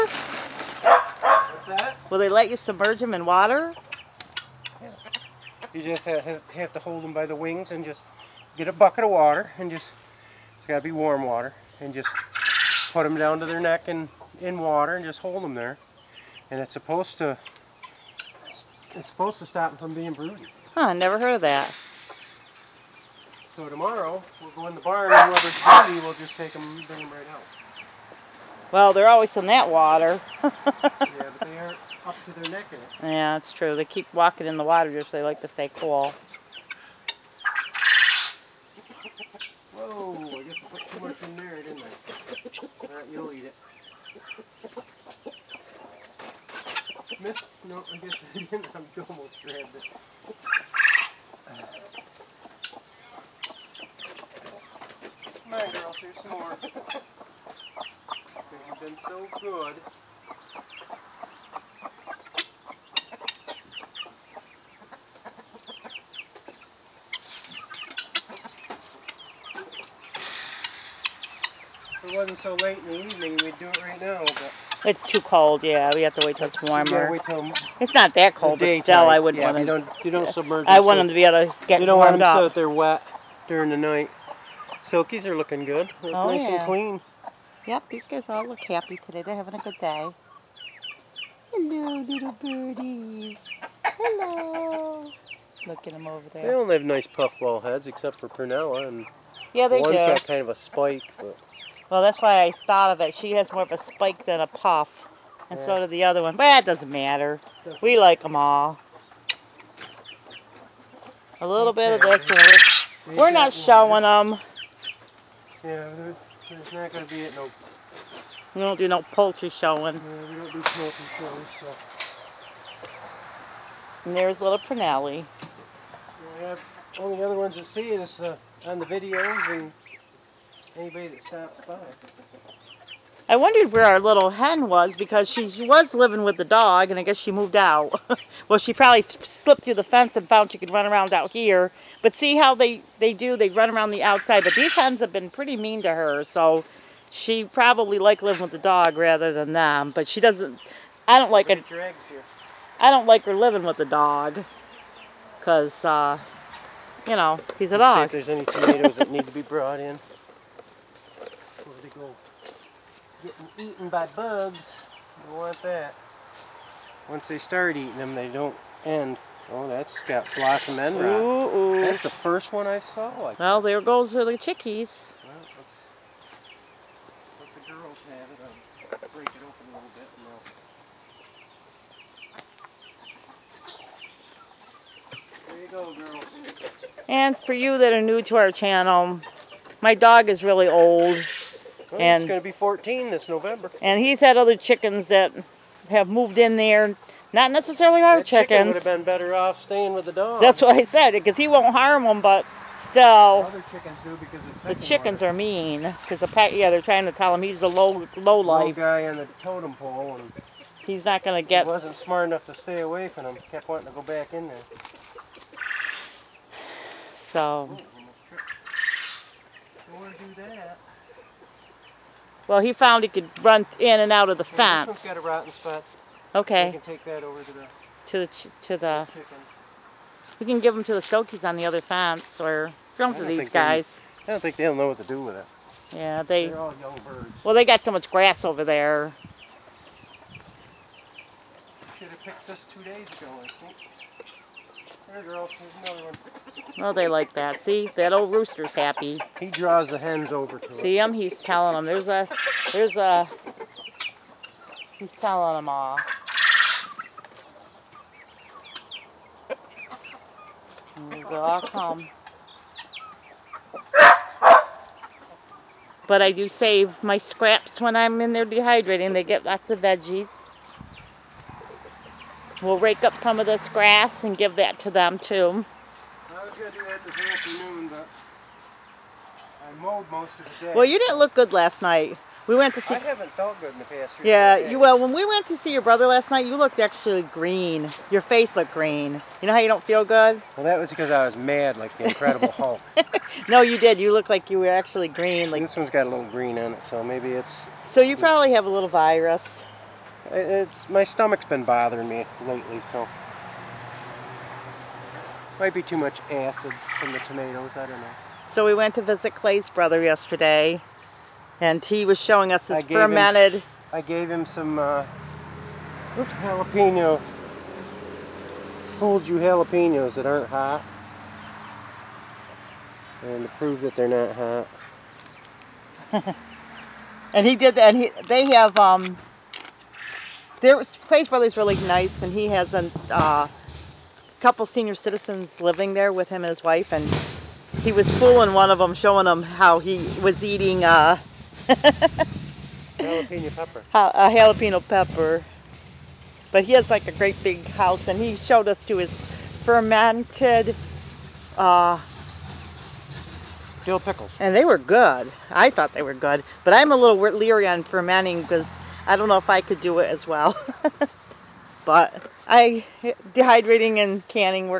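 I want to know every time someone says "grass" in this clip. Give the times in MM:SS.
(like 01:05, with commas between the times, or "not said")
03:58, 04:33.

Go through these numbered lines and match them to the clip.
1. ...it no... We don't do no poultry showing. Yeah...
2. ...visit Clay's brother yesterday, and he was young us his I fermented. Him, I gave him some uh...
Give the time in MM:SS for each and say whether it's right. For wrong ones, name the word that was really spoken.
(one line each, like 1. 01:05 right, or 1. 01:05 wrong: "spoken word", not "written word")
1. 01:57 right
2. 05:09 wrong: "showing", not "young".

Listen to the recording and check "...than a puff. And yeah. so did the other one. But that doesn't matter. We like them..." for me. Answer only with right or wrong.
right.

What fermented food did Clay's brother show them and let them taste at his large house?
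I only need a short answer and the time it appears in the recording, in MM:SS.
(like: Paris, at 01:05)
Dill pickles, at 05:53.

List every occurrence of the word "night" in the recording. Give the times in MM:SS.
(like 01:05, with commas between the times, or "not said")
01:23, 04:41, 04:46.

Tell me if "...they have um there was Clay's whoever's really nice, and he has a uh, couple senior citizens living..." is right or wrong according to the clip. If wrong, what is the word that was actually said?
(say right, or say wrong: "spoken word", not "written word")
wrong: "brother", not "whoever".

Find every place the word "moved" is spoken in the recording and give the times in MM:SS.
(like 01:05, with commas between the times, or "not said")
02:17, 03:16.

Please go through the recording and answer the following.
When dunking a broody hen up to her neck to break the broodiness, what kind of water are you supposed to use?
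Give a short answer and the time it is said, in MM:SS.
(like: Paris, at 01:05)
Warm water, at 00:10.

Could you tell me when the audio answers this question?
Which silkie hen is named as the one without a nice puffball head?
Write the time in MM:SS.
01:38.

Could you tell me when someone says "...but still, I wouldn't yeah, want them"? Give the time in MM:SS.
01:18.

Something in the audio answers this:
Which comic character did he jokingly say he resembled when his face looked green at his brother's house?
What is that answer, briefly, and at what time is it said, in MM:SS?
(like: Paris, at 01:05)
The Incredible Hulk, at 04:52.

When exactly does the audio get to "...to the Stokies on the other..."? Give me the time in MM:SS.
03:50.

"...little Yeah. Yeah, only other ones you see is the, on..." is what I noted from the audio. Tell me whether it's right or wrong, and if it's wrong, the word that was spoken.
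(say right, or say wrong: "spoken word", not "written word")
wrong: "Pernelli", not "Yeah".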